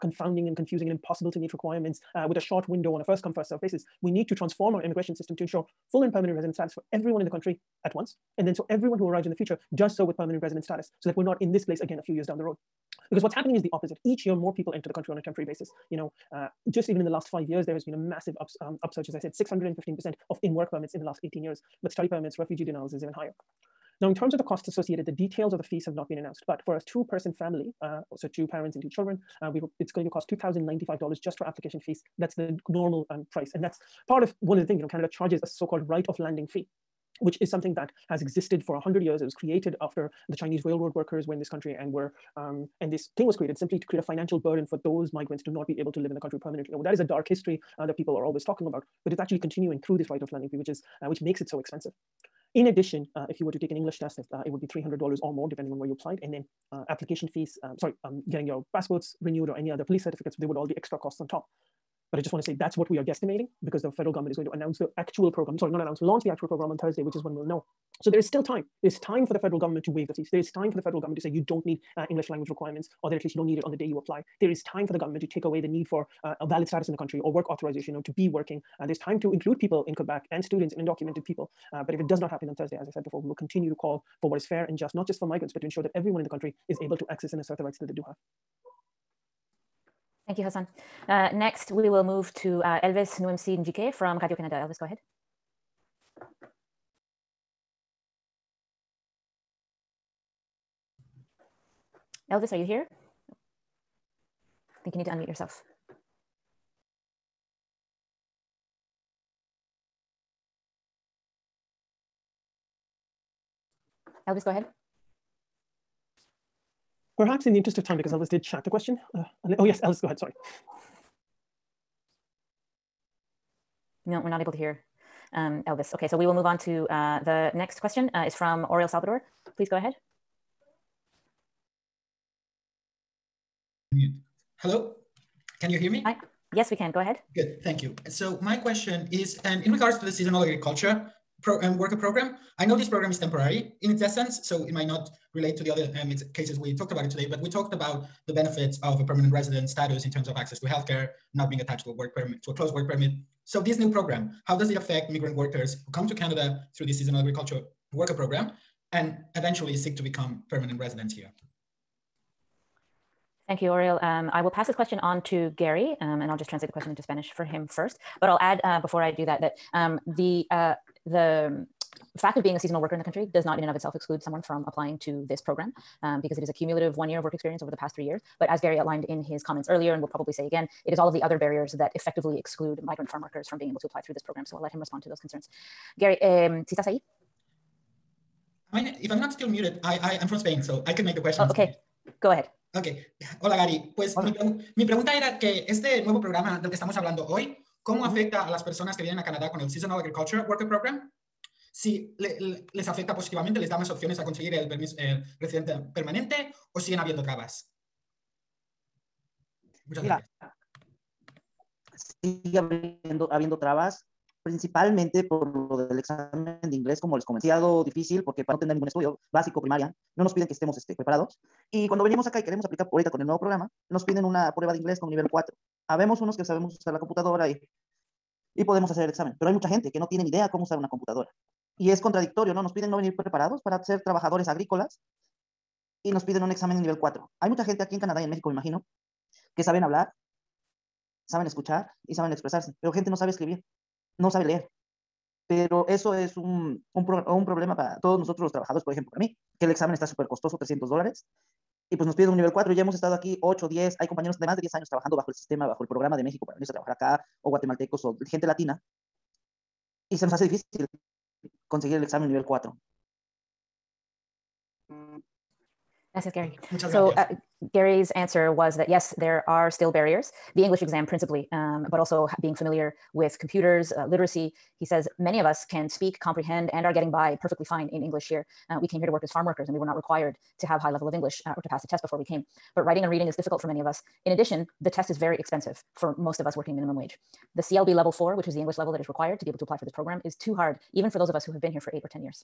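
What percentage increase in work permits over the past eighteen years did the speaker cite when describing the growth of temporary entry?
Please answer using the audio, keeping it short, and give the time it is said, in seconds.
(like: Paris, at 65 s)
615%, at 19 s.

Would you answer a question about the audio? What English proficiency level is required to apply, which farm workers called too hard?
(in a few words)
CLB level 4.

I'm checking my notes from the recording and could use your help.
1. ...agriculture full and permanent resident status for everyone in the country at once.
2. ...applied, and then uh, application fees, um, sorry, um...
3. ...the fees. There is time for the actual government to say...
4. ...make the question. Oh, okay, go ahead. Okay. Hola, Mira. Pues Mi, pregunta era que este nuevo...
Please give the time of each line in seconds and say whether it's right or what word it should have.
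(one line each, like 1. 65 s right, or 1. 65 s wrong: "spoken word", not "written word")
1. 5 s wrong: "ensure", not "agriculture"
2. 55 s right
3. 70 s wrong: "federal", not "actual"
4. 191 s wrong: "Gary", not "Mira".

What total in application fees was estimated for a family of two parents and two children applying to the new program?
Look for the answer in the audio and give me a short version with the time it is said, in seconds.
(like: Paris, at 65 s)
$2,095, at 30 s.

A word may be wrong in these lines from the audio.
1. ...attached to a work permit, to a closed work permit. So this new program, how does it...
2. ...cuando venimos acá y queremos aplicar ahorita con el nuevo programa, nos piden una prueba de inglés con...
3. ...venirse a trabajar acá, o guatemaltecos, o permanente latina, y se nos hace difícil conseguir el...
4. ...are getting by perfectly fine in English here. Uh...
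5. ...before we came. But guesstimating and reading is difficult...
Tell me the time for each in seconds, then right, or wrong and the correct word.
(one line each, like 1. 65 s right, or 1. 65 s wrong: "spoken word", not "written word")
1. 151 s right
2. 221 s right
3. 256 s wrong: "gente", not "permanente"
4. 276 s right
5. 282 s wrong: "writing", not "guesstimating".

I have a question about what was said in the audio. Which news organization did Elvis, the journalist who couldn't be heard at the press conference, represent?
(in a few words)
Radio Canada.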